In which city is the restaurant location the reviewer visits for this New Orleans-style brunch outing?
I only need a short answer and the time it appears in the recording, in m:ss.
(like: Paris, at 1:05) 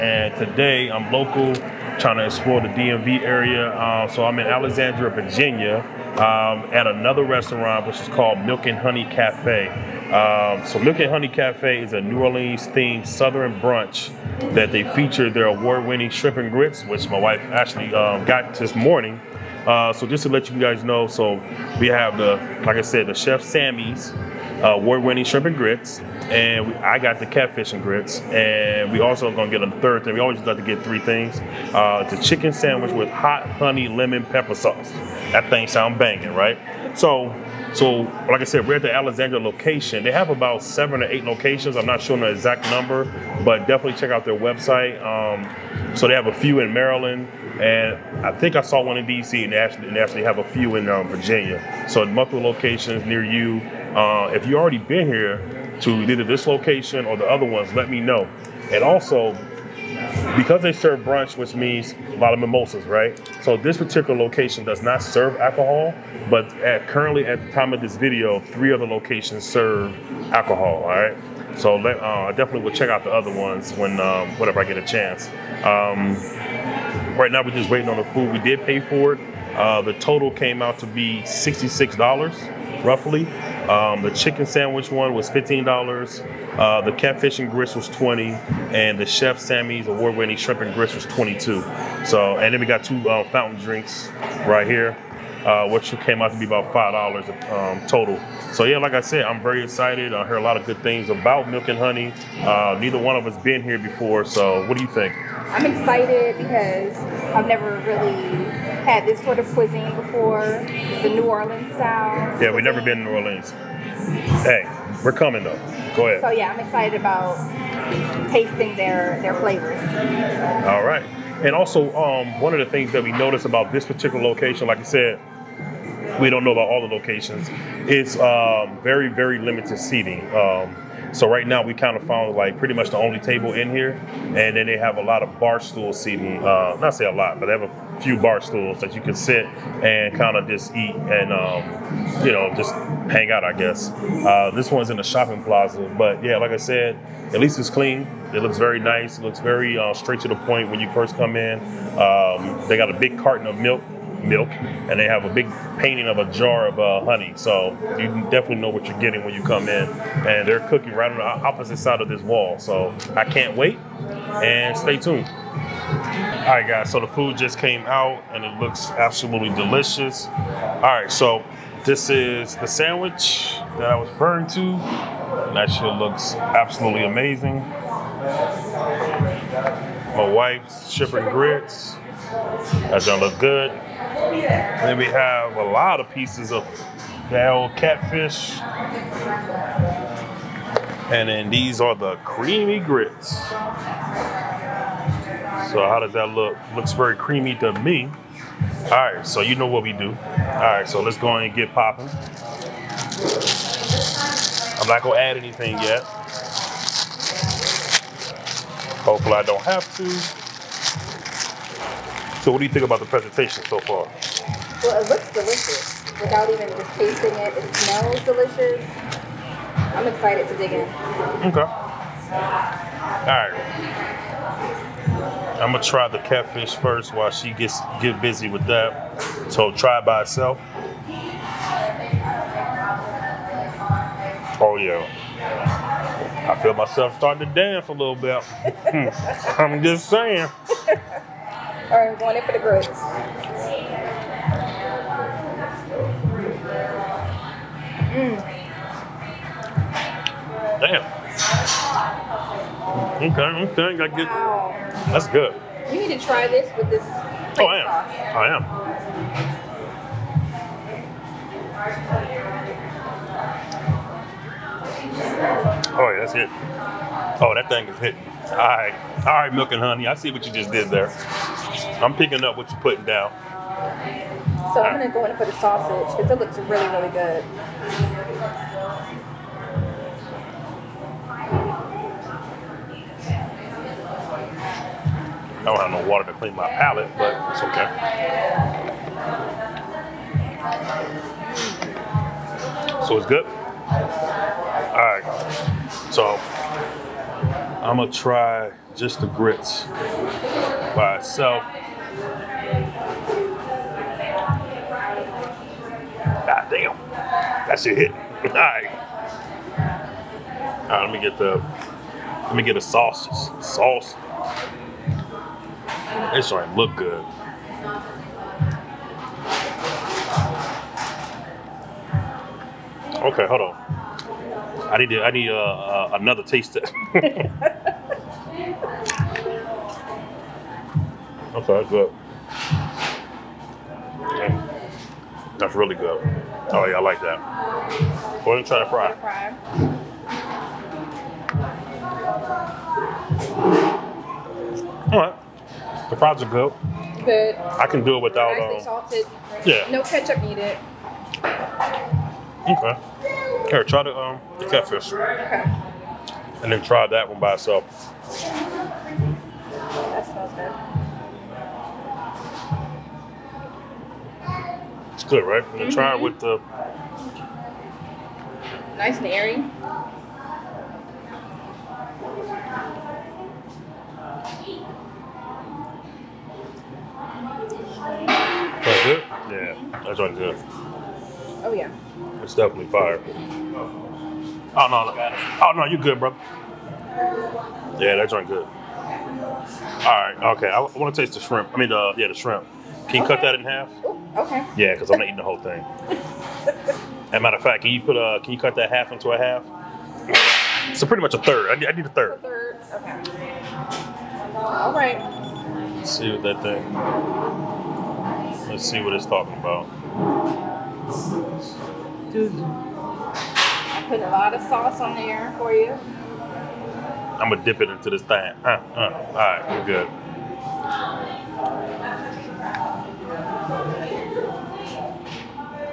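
Alexandria, Virginia, at 0:04.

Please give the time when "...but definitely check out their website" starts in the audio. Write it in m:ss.
0:43.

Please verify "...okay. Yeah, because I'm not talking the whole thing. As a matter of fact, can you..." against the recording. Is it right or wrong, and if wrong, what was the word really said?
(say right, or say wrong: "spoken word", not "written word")
wrong: "eating", not "talking".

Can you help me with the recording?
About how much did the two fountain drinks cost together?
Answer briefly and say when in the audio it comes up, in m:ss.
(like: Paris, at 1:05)
$5, at 1:36.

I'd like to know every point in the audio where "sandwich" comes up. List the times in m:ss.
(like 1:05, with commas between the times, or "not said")
0:32, 1:24, 2:52.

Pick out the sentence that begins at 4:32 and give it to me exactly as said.
I'm picking up what you're putting down.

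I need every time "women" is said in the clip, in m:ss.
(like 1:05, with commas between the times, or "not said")
not said.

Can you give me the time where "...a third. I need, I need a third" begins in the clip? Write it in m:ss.
6:41.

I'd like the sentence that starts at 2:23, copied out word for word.
I guess uh, this one's in a shopping plaza, but yeah, like I said, at least it's clean.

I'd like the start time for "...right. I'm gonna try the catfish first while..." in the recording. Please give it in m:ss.
3:43.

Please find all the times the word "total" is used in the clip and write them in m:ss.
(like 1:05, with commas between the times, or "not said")
1:19, 1:37.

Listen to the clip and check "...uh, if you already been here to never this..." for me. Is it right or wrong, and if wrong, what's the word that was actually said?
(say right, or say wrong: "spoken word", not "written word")
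wrong: "either", not "never".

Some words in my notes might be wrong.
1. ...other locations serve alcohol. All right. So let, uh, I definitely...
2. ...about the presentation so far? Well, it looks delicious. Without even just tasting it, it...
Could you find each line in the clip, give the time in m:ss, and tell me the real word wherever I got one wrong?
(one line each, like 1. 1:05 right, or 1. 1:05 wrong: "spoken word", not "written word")
1. 1:08 right
2. 3:32 right.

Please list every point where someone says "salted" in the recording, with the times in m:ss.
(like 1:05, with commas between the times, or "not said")
5:48.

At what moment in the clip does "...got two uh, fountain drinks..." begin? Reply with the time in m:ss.
1:32.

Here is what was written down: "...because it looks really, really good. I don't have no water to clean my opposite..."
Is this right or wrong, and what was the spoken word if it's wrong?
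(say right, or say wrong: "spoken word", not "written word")
wrong: "palate", not "opposite".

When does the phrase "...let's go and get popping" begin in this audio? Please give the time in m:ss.
3:21.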